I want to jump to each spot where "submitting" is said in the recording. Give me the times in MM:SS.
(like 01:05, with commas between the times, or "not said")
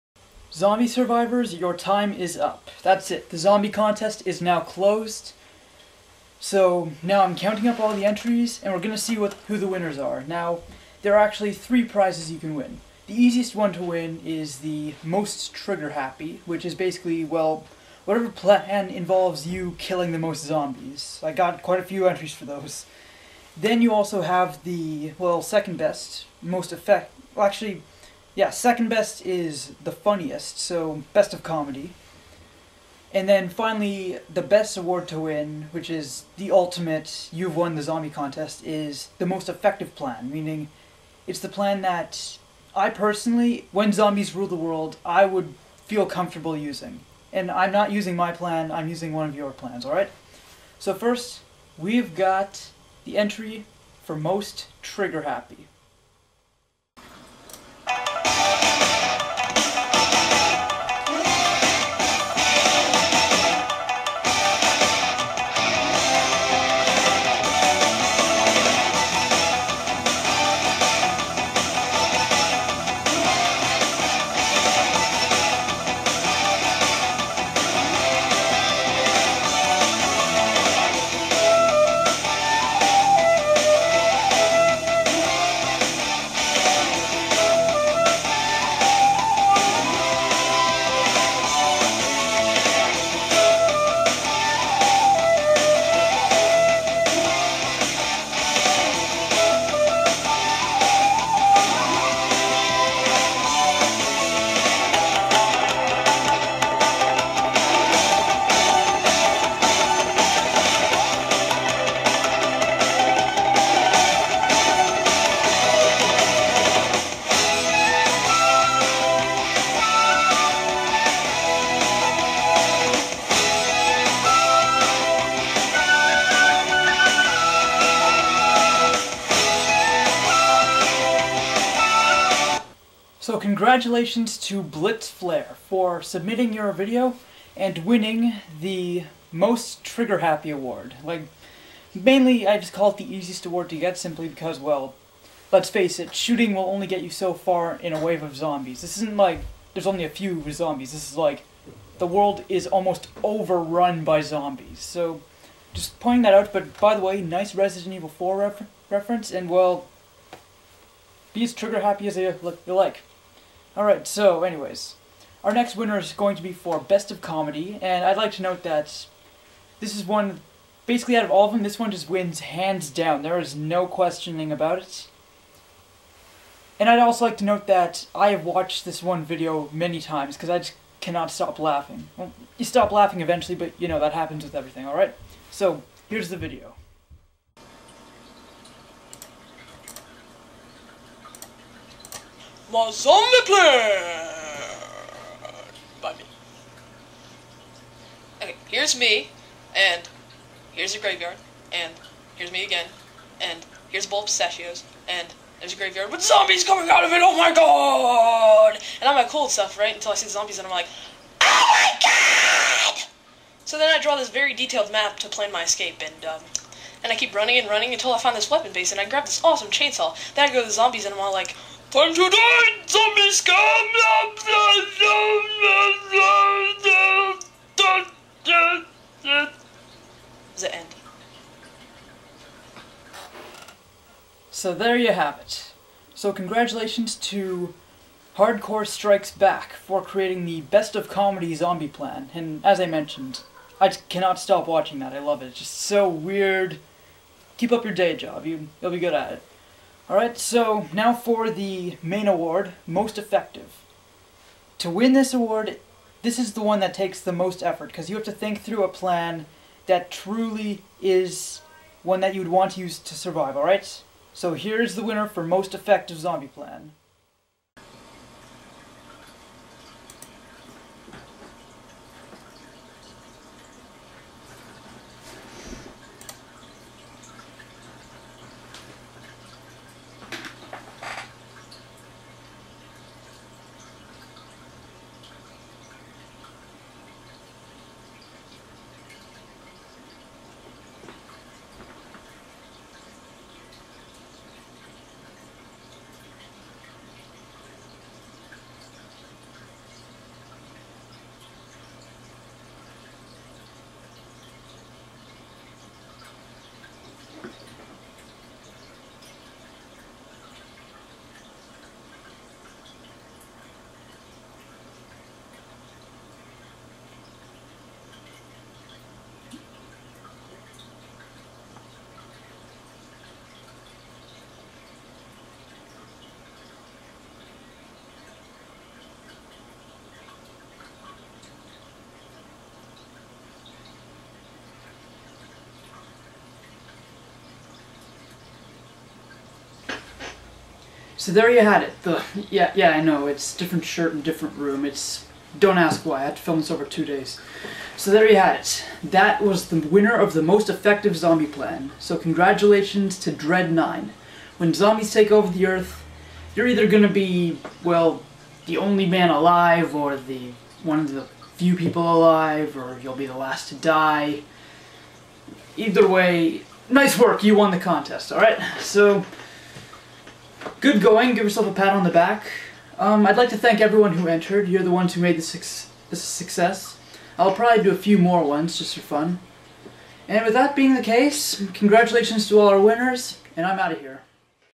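02:16.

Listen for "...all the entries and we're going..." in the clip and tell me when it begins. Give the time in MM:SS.
00:07.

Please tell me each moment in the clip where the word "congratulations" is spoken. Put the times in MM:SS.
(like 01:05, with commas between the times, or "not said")
02:13, 03:56, 05:52, 06:21.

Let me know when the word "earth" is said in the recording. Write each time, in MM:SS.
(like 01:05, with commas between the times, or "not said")
05:55.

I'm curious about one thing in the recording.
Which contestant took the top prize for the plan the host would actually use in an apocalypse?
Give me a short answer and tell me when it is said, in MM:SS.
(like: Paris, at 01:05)
Dread 9, at 05:53.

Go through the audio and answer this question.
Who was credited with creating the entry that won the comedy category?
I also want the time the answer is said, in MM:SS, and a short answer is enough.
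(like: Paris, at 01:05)
Hardcore Strikes Back, at 03:58.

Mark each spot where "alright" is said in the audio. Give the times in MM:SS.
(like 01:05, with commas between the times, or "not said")
00:49, 02:43, 03:04, 04:10, 04:23, 06:08.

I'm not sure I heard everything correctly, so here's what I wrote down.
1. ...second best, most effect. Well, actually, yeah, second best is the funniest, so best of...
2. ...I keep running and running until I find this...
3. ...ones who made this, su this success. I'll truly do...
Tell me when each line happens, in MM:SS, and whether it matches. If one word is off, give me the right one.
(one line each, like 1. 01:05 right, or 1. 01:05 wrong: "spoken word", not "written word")
1. 00:25 right
2. 03:37 right
3. 06:14 wrong: "probably", not "truly".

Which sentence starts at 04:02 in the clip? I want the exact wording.
And as I mentioned, I cannot stop watching that.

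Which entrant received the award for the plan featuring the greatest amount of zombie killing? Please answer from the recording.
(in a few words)
Blitzflare.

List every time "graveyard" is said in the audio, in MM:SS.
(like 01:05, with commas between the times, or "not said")
03:20, 03:25.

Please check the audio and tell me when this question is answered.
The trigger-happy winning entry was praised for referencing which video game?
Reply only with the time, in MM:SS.
02:37.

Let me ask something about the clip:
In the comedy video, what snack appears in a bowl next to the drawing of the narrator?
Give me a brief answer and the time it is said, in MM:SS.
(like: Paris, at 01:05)
pistachios, at 03:24.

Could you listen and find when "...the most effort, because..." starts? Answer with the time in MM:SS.
04:17.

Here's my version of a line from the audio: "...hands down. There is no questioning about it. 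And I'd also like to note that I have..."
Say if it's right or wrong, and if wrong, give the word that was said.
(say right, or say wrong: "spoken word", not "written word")
right.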